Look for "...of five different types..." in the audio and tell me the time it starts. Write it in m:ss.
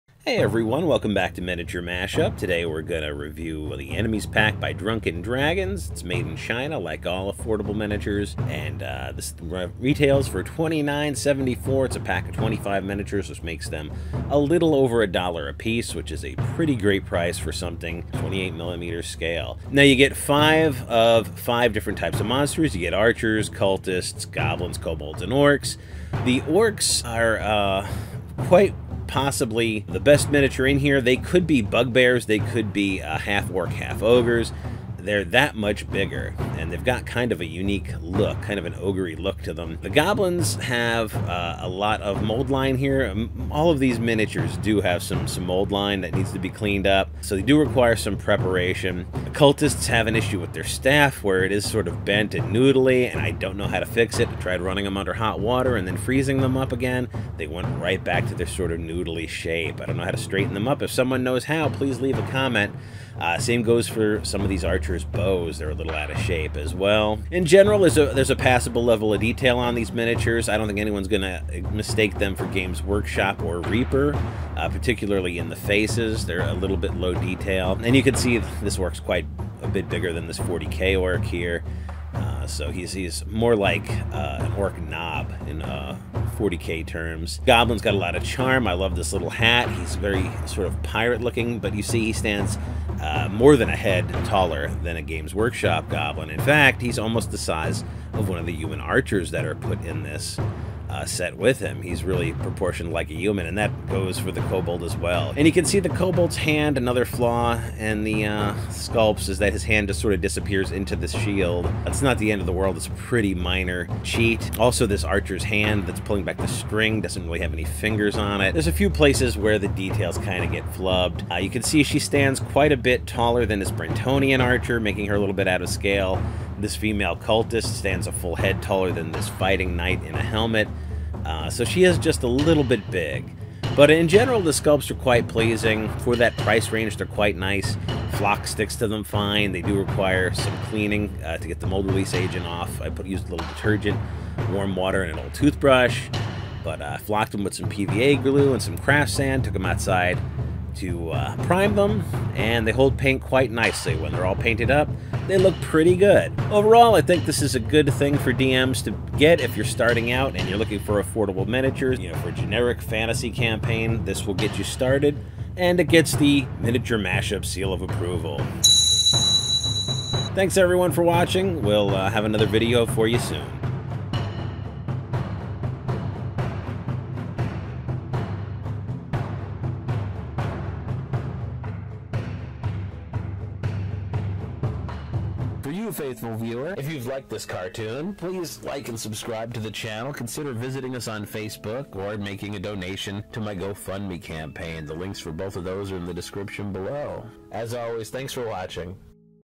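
0:20.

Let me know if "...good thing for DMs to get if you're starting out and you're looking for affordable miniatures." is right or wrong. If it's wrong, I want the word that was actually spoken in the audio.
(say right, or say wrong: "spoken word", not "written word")
right.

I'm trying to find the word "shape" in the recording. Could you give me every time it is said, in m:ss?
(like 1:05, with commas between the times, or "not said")
0:59, 1:06.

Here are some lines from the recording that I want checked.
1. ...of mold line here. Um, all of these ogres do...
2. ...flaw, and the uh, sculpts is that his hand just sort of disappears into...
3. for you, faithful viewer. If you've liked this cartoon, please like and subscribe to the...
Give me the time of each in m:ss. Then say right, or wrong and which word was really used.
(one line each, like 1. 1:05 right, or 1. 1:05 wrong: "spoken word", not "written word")
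1. 0:42 wrong: "miniatures", not "ogres"
2. 1:47 right
3. 3:05 right.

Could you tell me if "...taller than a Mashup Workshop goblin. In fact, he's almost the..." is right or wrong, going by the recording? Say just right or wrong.
wrong.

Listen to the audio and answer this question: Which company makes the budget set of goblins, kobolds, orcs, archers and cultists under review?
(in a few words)
Drunk'n Dragons.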